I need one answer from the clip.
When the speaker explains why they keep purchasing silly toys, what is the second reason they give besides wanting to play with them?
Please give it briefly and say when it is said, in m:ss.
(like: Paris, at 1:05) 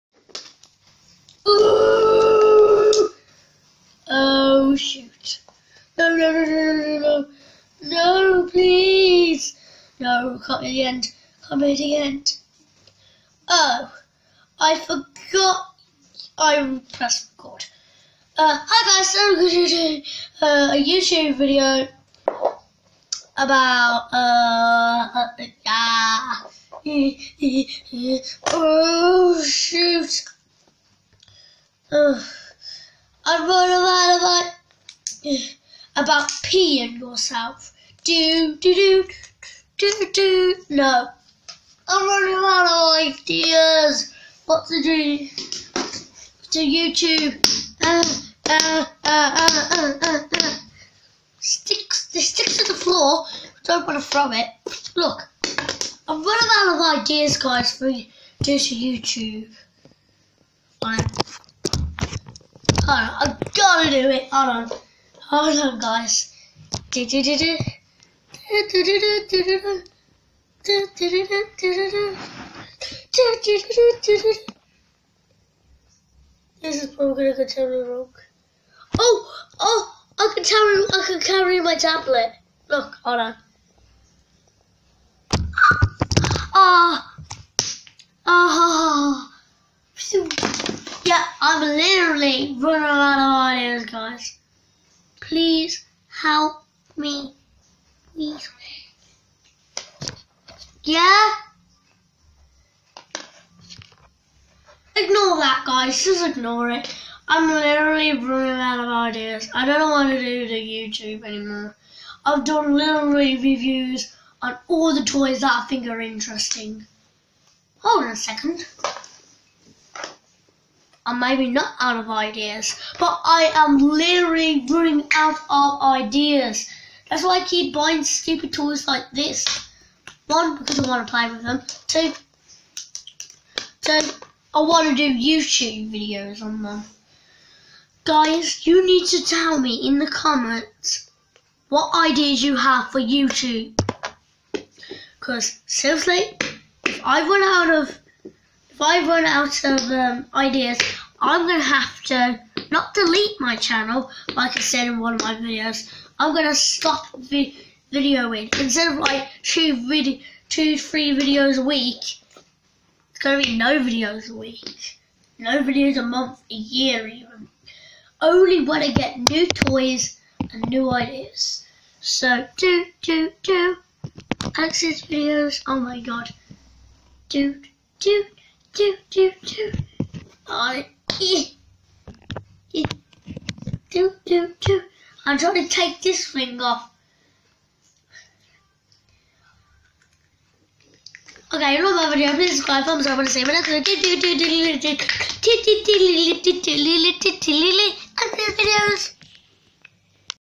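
To do YouTube videos on them, at 2:14.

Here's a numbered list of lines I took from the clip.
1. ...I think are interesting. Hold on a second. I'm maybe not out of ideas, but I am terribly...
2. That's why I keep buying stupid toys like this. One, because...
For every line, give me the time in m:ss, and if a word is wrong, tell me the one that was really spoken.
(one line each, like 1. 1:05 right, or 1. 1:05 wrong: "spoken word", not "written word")
1. 1:55 wrong: "literally", not "terribly"
2. 2:07 right.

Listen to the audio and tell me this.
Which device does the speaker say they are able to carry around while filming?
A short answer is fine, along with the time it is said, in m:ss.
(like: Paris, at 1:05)
Tablet, at 1:21.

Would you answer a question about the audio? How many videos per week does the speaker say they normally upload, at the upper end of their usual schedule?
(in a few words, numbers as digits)
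3.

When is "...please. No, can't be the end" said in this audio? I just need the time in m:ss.
0:08.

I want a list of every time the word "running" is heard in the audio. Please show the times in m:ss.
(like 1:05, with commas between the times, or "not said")
0:33, 0:42, 0:56, 1:32, 1:48, 2:04.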